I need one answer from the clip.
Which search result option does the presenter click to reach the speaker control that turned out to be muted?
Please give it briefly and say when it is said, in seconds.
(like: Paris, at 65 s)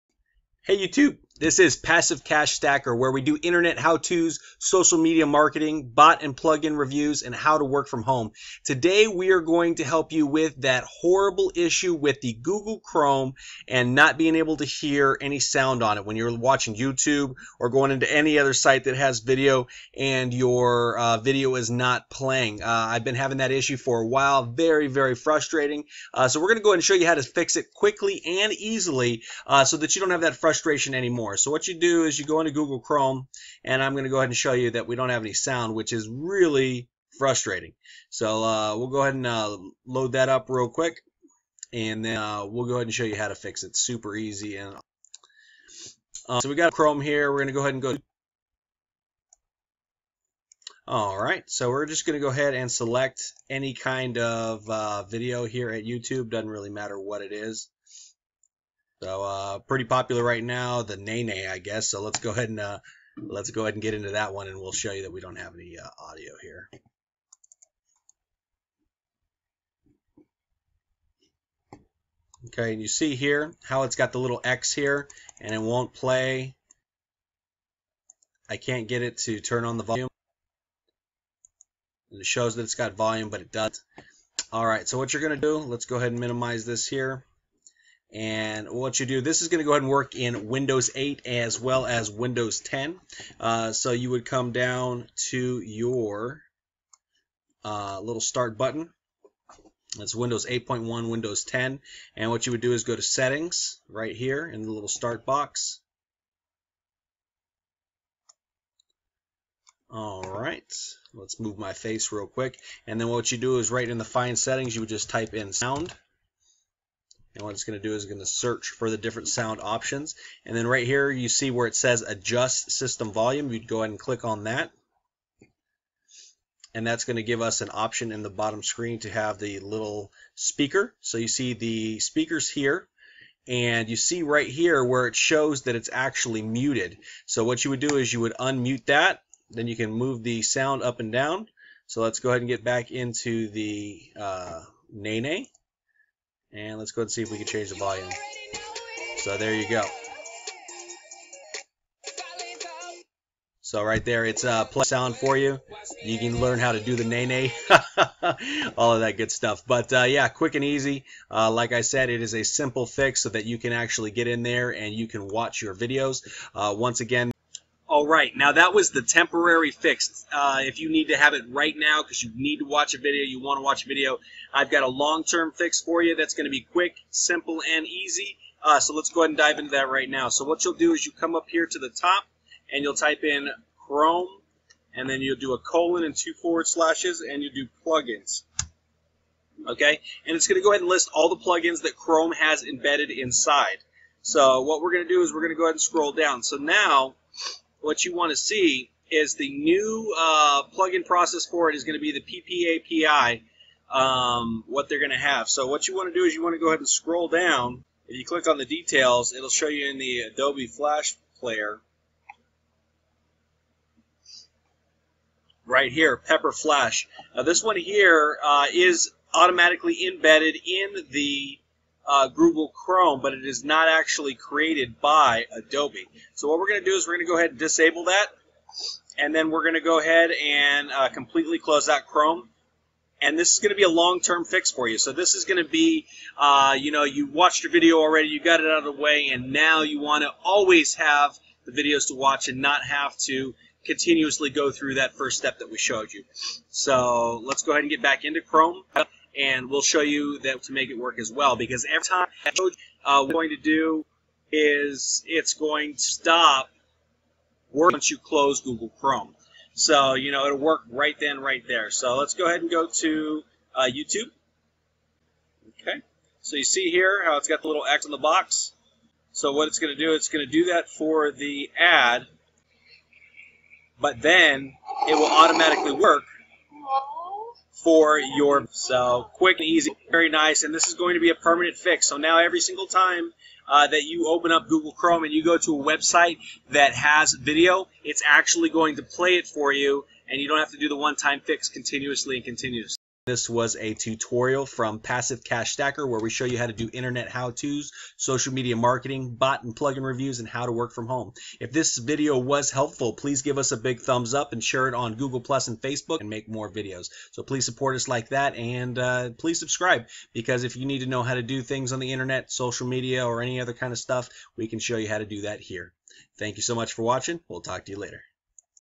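adjust system volume, at 122 s.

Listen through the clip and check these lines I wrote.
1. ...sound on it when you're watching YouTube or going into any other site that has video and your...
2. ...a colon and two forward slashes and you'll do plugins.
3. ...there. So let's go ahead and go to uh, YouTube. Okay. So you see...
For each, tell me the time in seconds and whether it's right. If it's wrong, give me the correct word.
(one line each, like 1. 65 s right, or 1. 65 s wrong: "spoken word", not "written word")
1. 15 s right
2. 185 s right
3. 261 s right.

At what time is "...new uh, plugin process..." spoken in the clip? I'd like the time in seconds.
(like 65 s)
199 s.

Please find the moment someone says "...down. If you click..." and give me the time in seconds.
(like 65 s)
207 s.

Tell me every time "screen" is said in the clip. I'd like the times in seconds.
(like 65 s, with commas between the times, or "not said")
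128 s.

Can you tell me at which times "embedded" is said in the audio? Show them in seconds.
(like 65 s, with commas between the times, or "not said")
192 s, 220 s.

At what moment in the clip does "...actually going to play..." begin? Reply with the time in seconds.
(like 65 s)
288 s.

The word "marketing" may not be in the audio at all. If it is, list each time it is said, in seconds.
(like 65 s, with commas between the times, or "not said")
5 s, 298 s.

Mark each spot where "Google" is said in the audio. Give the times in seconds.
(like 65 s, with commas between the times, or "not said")
12 s, 32 s, 222 s, 258 s, 284 s, 305 s.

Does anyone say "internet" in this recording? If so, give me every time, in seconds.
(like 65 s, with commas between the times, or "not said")
3 s, 296 s, 312 s.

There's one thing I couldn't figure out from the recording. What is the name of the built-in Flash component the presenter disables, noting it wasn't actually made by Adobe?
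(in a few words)
Pepper Flash.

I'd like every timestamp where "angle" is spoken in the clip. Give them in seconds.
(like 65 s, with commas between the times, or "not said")
not said.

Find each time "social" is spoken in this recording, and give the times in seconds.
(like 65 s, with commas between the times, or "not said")
4 s, 298 s, 312 s.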